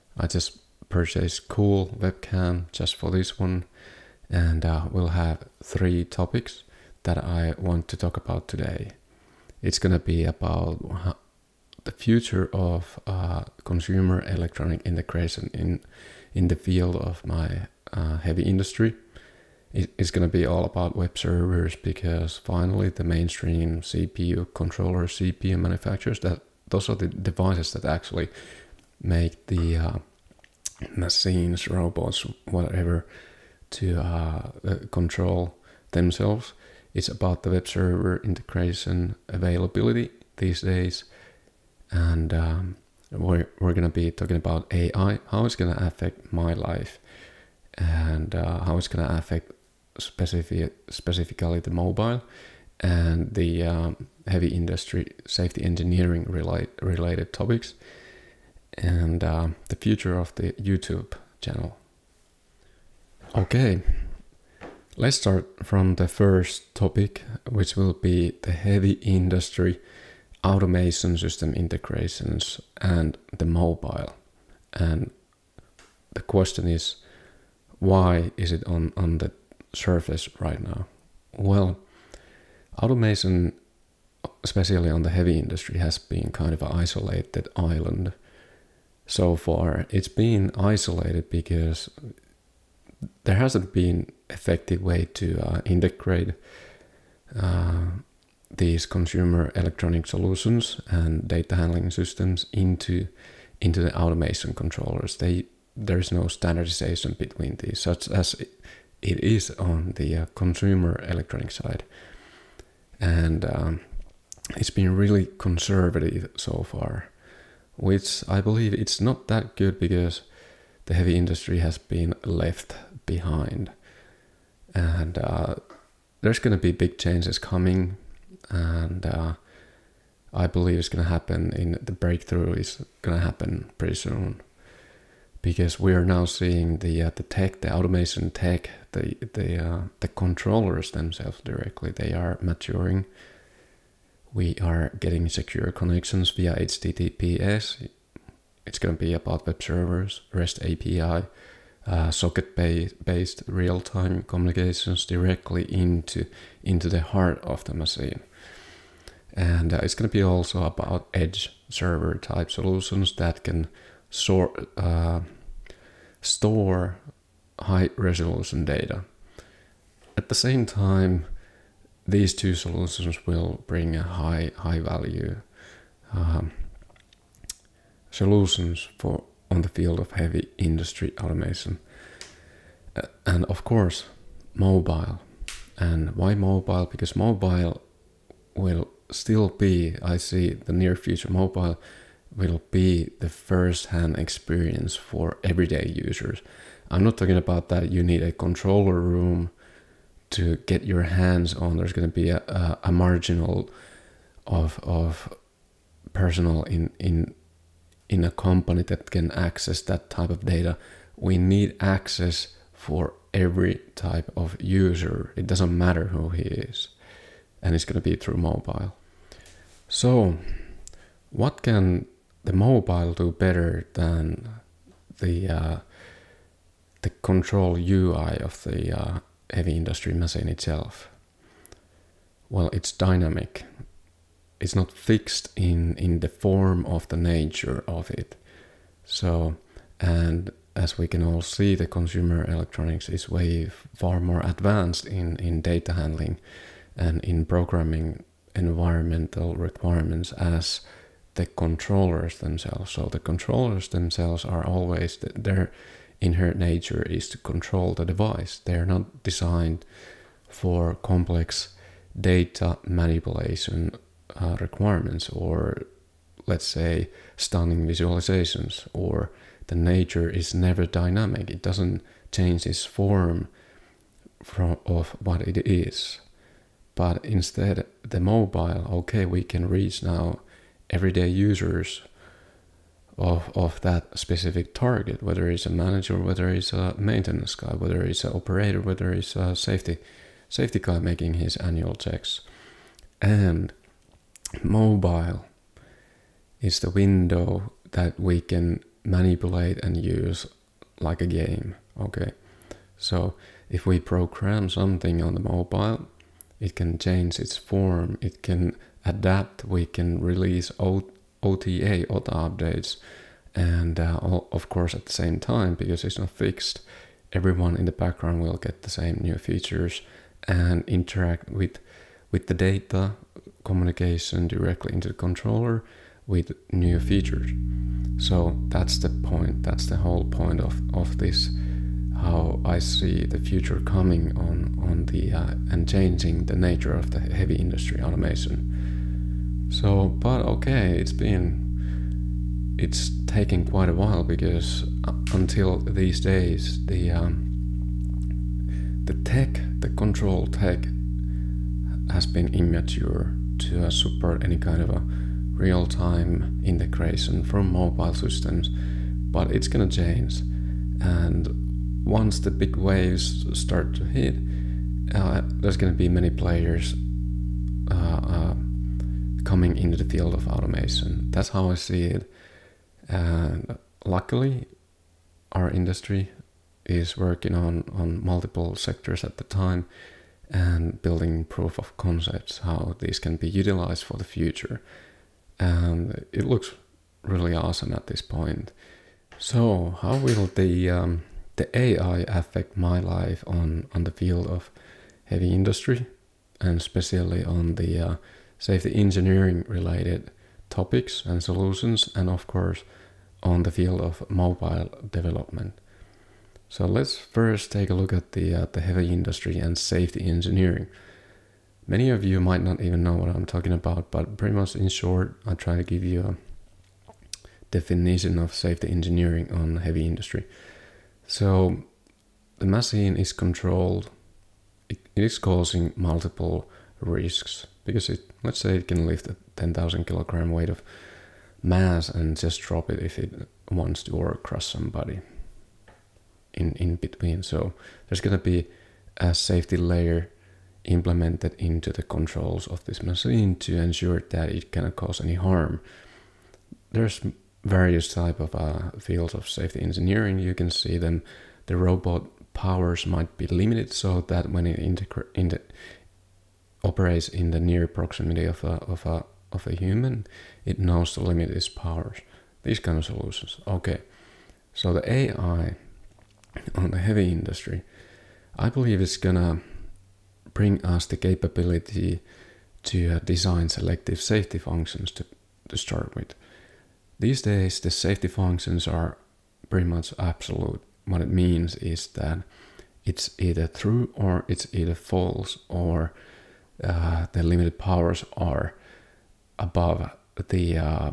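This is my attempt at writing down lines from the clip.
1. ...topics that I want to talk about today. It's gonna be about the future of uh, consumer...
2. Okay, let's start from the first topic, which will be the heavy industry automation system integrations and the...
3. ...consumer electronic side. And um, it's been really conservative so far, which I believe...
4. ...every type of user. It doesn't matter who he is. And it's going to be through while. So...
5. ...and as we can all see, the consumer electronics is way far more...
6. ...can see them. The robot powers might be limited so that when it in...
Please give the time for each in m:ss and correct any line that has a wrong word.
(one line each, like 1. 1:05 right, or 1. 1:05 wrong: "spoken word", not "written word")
1. 0:06 right
2. 1:03 right
3. 1:50 right
4. 3:33 wrong: "mobile", not "while"
5. 3:59 right
6. 7:30 right.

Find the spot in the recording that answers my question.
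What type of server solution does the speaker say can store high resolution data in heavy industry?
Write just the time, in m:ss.
2:41.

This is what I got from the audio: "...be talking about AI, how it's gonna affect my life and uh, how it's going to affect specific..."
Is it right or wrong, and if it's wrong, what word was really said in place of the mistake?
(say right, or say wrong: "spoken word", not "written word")
right.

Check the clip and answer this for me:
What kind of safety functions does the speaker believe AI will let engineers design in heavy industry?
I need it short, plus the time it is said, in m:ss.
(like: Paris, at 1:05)
selective safety functions, at 7:53.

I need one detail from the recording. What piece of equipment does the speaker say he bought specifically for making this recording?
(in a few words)
webcam.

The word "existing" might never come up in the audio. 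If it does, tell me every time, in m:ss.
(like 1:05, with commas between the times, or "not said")
not said.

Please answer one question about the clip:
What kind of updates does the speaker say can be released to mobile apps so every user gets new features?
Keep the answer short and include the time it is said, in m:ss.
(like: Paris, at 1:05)
OTA updates, at 5:11.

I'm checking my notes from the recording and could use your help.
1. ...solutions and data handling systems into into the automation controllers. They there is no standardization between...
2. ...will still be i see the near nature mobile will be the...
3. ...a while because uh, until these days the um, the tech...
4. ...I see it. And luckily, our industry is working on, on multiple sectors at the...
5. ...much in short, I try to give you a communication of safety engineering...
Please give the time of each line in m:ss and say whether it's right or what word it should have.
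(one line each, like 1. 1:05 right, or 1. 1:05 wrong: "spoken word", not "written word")
1. 1:40 right
2. 3:08 wrong: "future", not "nature"
3. 5:43 right
4. 6:11 right
5. 6:54 wrong: "definition", not "communication".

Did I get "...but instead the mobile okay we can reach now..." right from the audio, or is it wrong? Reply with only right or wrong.
right.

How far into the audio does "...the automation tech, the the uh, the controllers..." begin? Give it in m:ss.
2:17.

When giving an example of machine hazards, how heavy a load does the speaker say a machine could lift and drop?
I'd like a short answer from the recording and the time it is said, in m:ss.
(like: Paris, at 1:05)
10,000 kilograms, at 7:09.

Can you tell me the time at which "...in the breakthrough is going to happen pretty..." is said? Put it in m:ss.
2:11.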